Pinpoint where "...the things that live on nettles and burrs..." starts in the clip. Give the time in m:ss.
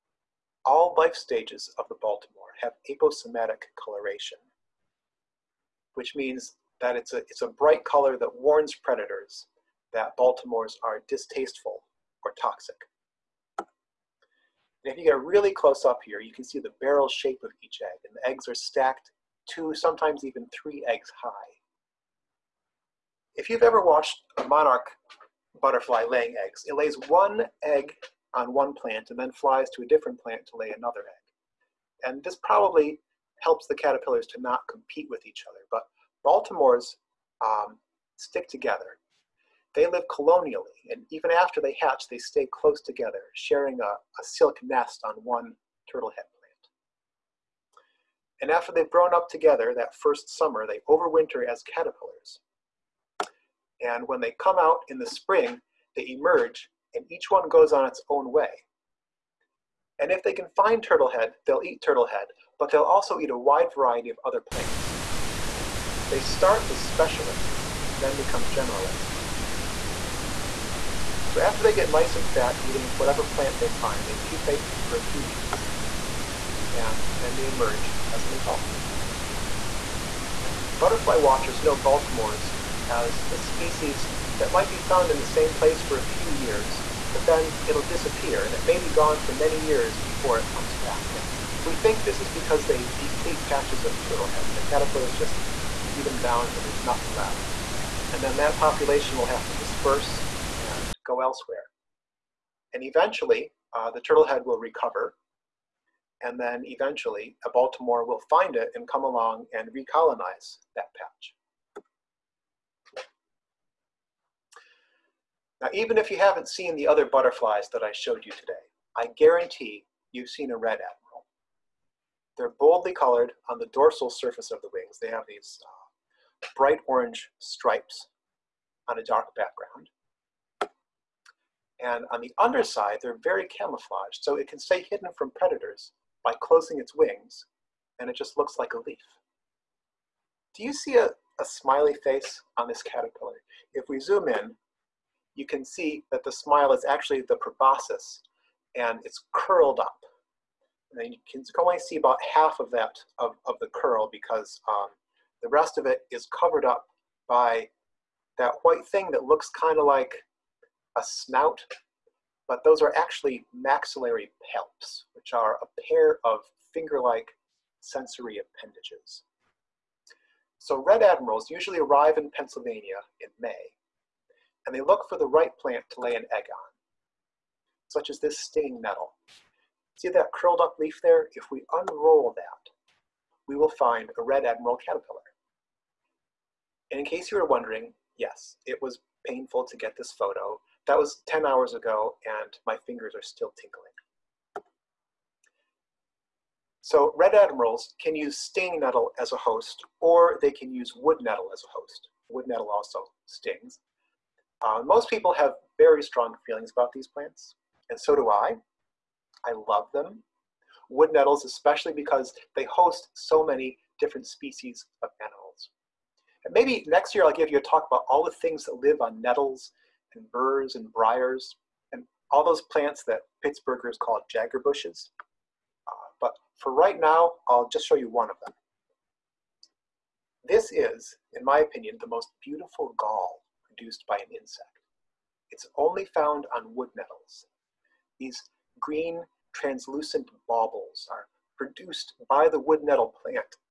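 3:38.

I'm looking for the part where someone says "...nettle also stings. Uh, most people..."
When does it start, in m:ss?
3:22.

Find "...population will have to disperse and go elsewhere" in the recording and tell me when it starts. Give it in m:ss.
1:38.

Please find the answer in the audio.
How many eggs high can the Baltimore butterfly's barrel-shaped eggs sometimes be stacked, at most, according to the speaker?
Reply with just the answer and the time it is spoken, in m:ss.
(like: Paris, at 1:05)
3, at 0:20.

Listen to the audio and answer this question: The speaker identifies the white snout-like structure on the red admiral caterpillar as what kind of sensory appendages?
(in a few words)
maxillary palps.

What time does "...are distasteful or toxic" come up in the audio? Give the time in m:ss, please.
0:10.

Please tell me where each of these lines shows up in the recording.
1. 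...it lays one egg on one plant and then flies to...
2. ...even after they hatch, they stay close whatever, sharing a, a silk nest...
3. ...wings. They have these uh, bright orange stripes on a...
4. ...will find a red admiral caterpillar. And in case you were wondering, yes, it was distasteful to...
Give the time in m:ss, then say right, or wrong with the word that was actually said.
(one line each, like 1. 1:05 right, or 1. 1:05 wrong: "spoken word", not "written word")
1. 0:26 right
2. 0:41 wrong: "together", not "whatever"
3. 2:04 right
4. 3:03 wrong: "painful", not "distasteful".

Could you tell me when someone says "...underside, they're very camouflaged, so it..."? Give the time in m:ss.
2:12.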